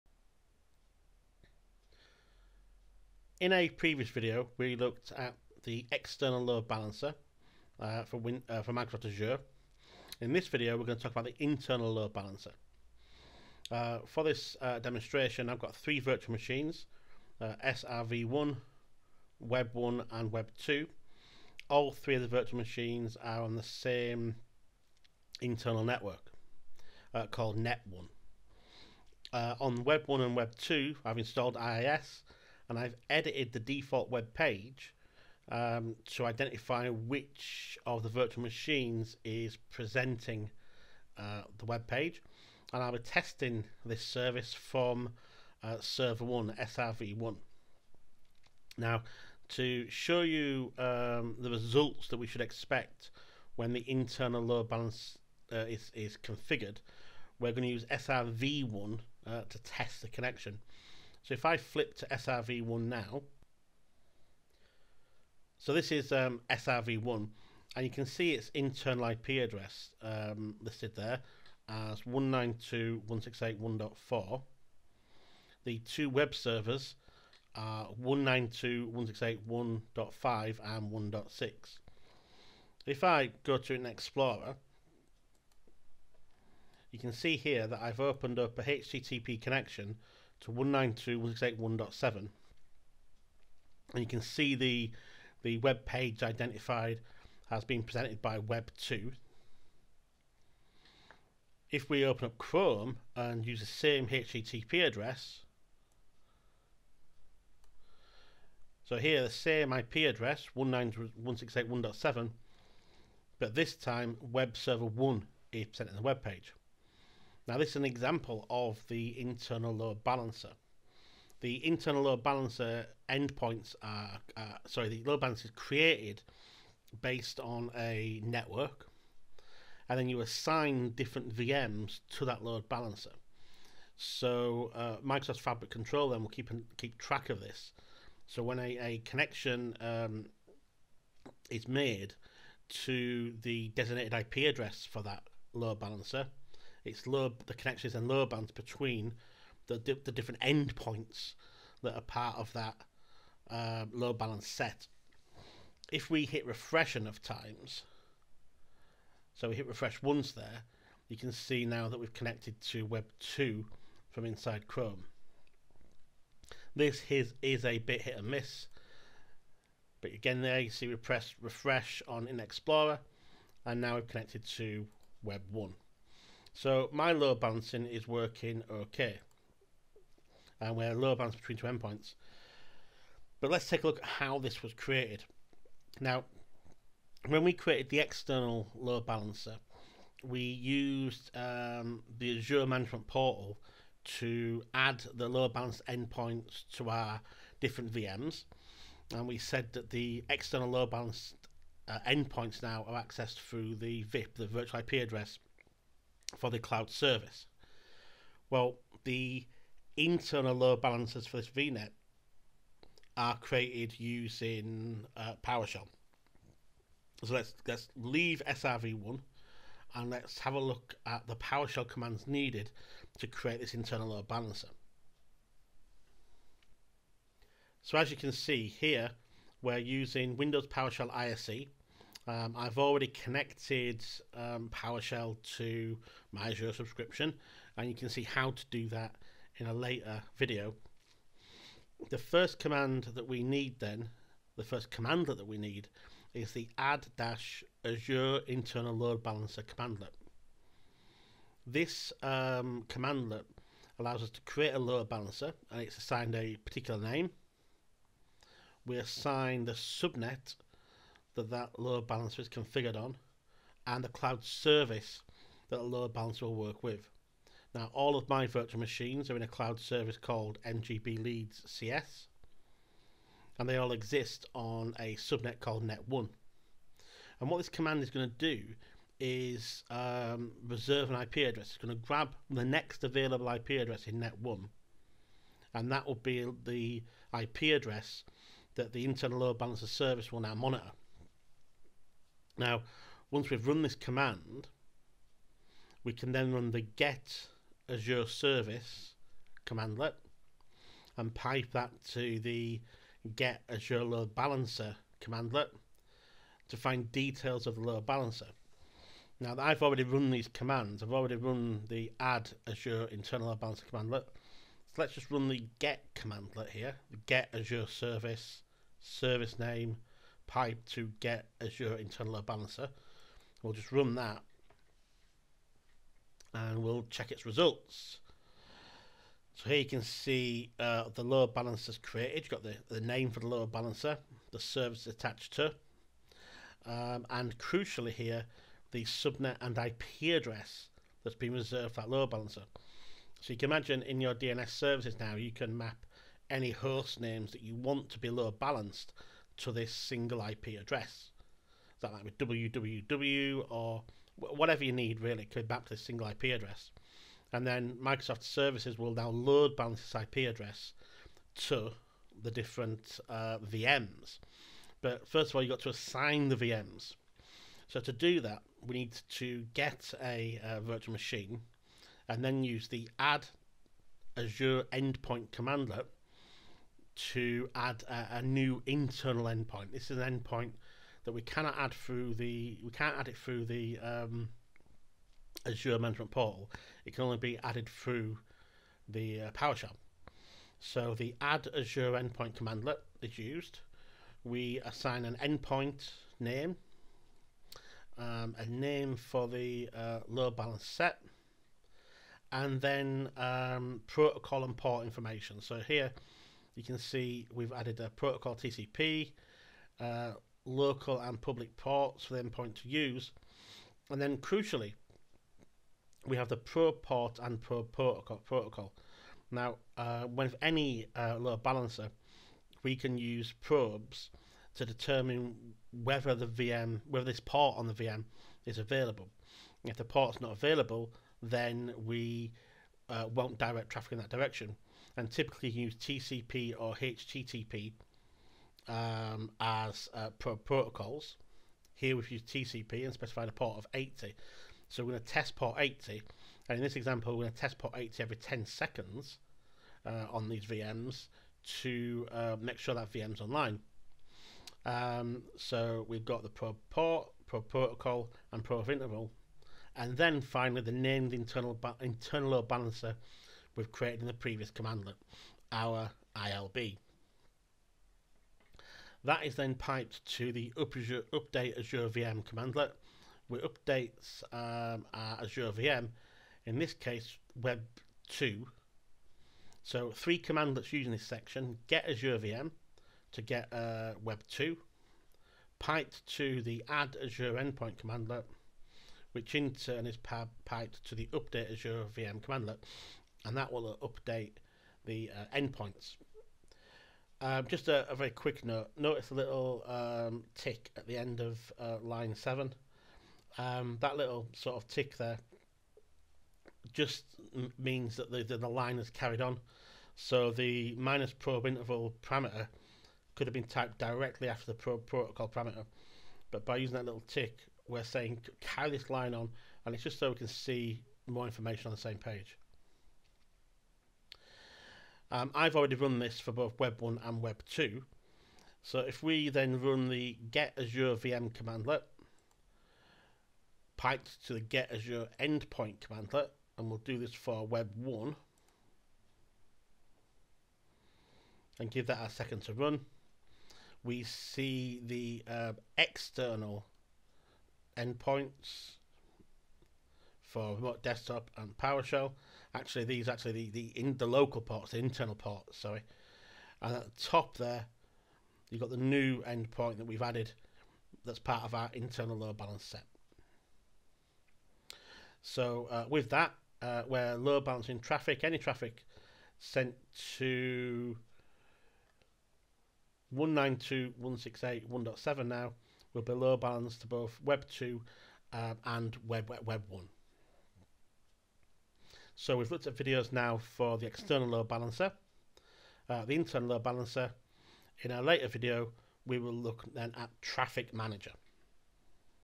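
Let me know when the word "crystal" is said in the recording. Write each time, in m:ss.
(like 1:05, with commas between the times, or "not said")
not said.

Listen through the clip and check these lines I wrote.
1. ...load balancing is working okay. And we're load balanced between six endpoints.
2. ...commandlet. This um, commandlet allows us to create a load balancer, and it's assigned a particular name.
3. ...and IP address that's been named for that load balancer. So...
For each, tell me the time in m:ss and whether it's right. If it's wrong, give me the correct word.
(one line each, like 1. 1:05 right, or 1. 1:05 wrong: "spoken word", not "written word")
1. 2:57 wrong: "two", not "six"
2. 4:09 right
3. 5:39 wrong: "reserved", not "named".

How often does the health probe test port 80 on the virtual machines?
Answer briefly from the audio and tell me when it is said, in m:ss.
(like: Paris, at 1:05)
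Every 10 seconds, at 7:28.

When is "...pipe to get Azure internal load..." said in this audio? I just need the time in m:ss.
5:20.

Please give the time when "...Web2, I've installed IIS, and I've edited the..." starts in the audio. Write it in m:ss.
0:30.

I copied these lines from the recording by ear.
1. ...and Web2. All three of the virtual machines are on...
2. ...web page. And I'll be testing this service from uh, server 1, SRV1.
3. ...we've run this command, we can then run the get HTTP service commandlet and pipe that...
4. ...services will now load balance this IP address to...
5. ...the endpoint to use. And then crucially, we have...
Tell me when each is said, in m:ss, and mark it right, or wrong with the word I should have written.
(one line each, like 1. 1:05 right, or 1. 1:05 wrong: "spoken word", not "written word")
1. 0:20 right
2. 0:41 right
3. 4:53 wrong: "Azure", not "HTTP"
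4. 5:58 right
5. 6:52 right.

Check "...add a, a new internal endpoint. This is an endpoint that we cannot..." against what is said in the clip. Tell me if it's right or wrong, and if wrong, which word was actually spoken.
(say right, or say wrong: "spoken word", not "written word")
right.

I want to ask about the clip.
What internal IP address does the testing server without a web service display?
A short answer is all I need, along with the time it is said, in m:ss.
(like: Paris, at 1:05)
192.168.1.4, at 1:12.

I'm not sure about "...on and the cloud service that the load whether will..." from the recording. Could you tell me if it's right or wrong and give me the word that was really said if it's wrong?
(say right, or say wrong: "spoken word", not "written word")
wrong: "balancer", not "whether".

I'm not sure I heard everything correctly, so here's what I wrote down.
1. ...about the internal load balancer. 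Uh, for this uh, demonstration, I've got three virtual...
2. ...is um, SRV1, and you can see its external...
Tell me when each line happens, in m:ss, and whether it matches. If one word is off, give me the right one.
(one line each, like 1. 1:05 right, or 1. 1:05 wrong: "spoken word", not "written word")
1. 0:11 right
2. 1:05 wrong: "internal", not "external".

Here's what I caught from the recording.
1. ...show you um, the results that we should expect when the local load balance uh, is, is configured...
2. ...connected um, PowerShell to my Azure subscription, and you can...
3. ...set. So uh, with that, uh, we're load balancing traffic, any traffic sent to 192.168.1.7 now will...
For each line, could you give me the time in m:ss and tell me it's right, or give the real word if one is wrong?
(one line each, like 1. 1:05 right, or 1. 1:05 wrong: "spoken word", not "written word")
1. 0:49 wrong: "internal", not "local"
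2. 3:53 right
3. 9:22 right.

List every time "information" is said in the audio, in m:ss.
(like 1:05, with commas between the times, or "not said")
6:45, 8:41.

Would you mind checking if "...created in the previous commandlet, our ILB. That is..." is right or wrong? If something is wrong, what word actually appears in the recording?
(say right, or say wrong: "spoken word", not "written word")
right.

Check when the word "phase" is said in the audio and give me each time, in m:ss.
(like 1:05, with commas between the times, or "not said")
not said.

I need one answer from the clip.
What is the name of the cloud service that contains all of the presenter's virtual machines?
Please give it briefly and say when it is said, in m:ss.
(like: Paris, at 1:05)
NGB Leads CS, at 4:30.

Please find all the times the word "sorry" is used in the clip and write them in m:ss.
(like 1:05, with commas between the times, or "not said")
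2:04, 9:15.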